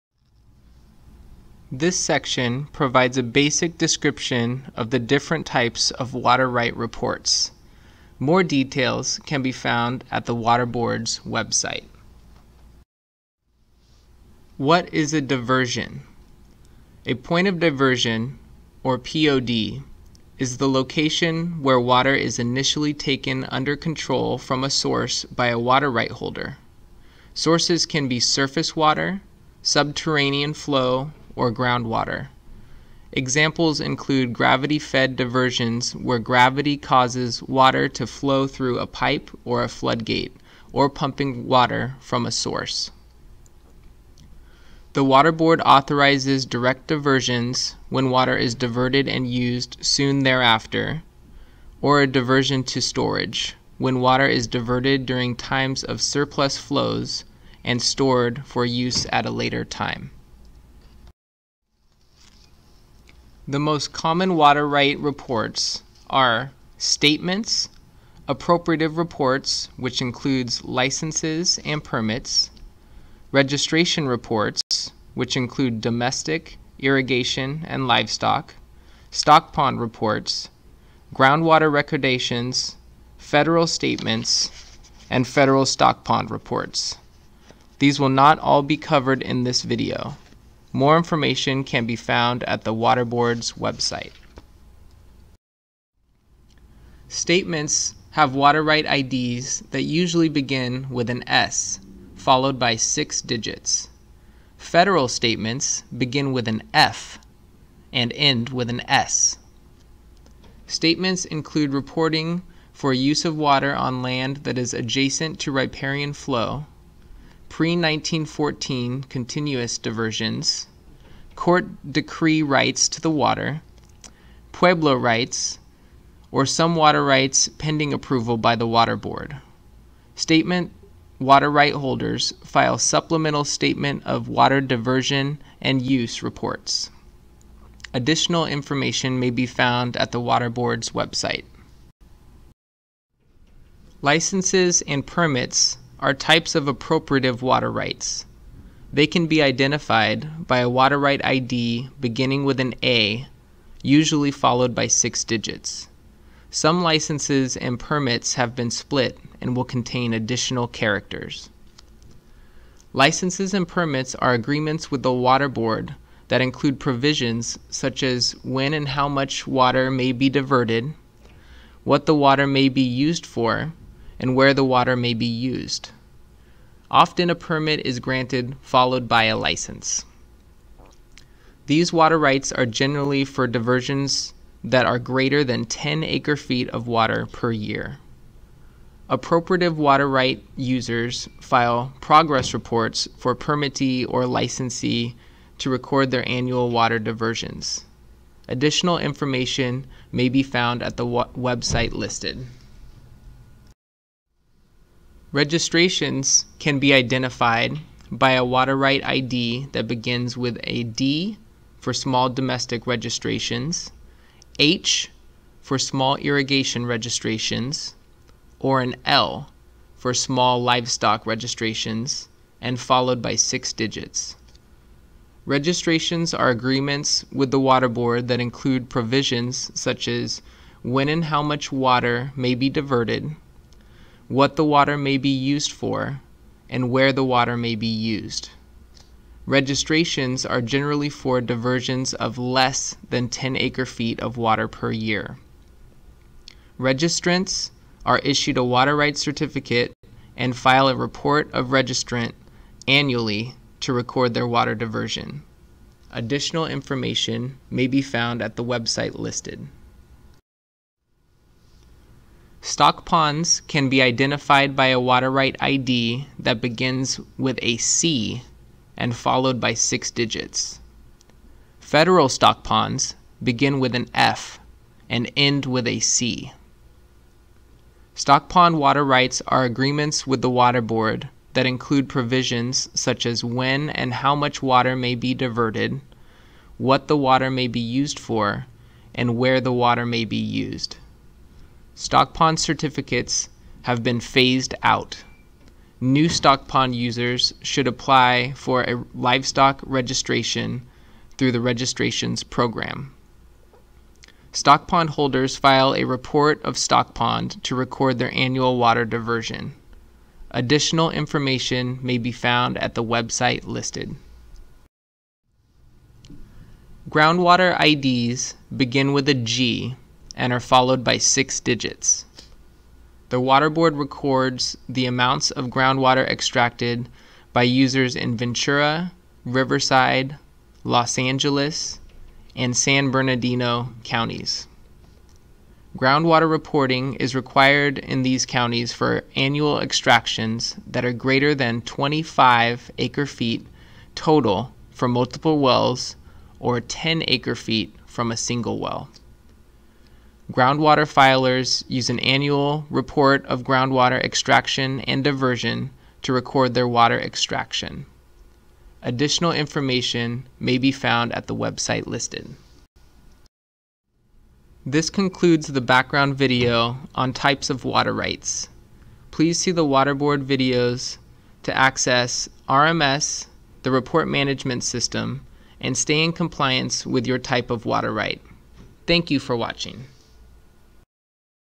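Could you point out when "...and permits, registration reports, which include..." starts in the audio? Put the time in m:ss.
1:11.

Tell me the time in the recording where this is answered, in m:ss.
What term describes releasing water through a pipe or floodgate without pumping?
0:34.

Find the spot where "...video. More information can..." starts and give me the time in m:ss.
1:29.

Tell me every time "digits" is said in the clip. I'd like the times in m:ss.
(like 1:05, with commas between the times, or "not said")
1:43, 2:35, 3:43, 4:30, 5:21.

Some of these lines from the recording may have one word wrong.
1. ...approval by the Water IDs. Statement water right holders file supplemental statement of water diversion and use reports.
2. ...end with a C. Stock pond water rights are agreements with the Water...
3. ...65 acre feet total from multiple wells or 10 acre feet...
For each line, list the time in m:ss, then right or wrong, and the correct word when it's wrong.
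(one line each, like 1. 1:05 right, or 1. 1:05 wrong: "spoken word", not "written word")
1. 2:07 wrong: "Board", not "IDs"
2. 4:35 right
3. 5:41 wrong: "25", not "65".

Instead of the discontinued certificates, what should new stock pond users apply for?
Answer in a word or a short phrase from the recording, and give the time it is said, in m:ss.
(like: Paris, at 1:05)
livestock registration, at 4:59.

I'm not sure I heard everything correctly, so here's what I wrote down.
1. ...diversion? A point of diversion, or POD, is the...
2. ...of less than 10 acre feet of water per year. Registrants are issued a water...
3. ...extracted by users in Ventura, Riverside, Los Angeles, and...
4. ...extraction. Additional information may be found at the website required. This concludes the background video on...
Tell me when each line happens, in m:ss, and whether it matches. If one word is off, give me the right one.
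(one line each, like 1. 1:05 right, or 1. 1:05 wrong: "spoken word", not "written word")
1. 0:15 right
2. 4:02 right
3. 5:26 right
4. 5:57 wrong: "listed", not "required".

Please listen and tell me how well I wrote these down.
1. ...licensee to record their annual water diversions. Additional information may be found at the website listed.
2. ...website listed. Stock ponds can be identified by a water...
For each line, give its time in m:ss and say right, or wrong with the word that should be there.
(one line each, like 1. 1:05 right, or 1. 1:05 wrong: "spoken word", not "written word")
1. 3:14 right
2. 4:18 right.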